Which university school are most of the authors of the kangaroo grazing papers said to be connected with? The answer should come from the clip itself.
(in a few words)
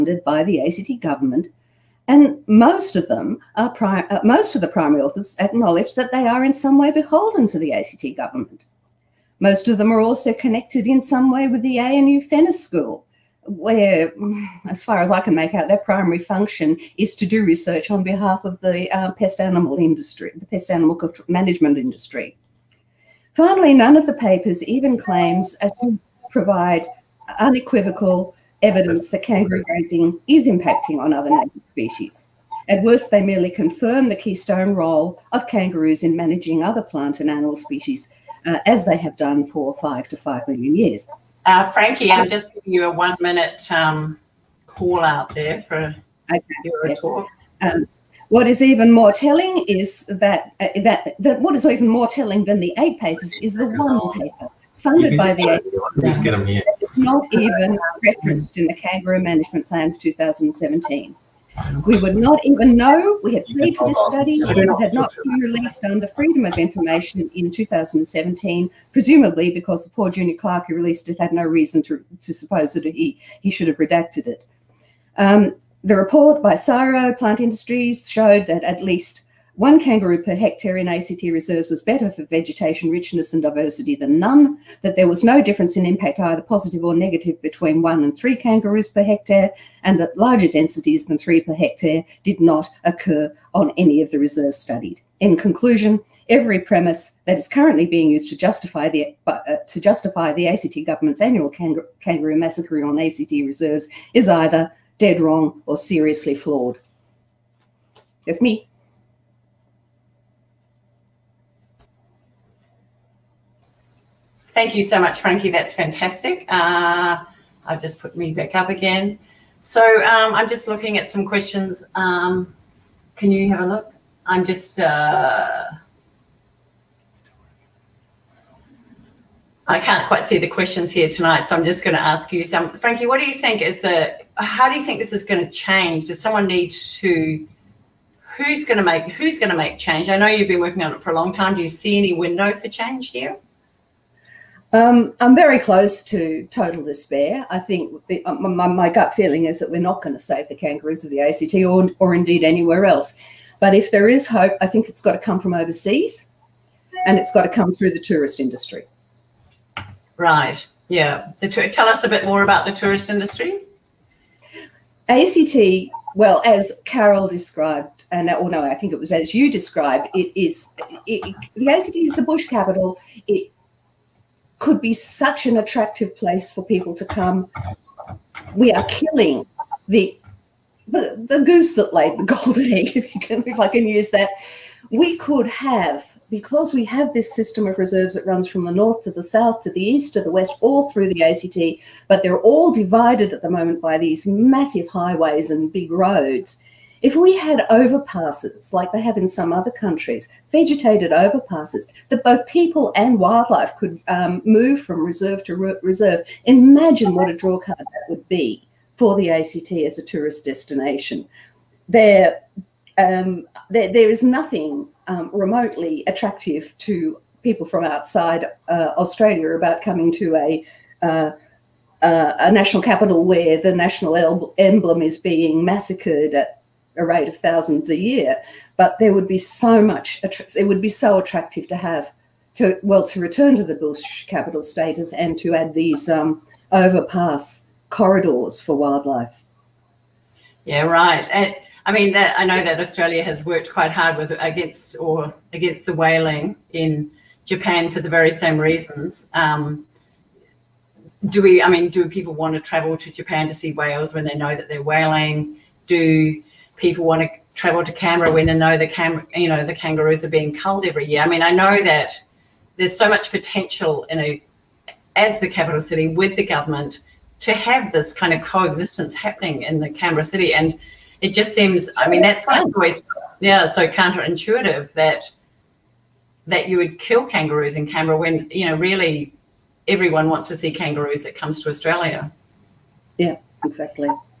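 ANU Fenner School.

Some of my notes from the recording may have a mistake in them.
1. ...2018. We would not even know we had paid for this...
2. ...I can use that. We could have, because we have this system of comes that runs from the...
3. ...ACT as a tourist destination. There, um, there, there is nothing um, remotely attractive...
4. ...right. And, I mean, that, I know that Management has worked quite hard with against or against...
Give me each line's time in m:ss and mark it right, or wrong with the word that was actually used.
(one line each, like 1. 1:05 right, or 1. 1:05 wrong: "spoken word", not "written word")
1. 0:59 wrong: "2017", not "2018"
2. 3:03 wrong: "reserves", not "comes"
3. 3:29 right
4. 4:00 wrong: "Australia", not "Management".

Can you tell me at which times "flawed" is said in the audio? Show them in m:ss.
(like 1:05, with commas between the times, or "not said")
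1:46.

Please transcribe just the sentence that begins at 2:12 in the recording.
Frankie, what do you think is the?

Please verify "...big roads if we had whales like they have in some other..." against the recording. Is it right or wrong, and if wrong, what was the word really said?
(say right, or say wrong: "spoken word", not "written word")
wrong: "overpasses", not "whales".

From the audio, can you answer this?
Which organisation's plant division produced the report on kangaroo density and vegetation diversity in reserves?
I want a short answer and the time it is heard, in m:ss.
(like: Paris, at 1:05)
CSIRO Plant Industries, at 1:16.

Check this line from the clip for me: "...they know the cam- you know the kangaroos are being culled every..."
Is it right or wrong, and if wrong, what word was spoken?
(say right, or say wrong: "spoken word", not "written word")
right.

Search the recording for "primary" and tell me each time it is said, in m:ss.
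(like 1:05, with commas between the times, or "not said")
0:04, 0:15.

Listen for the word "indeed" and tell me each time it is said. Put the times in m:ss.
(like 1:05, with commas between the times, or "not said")
2:32.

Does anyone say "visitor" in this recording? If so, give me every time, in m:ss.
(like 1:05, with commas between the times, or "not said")
not said.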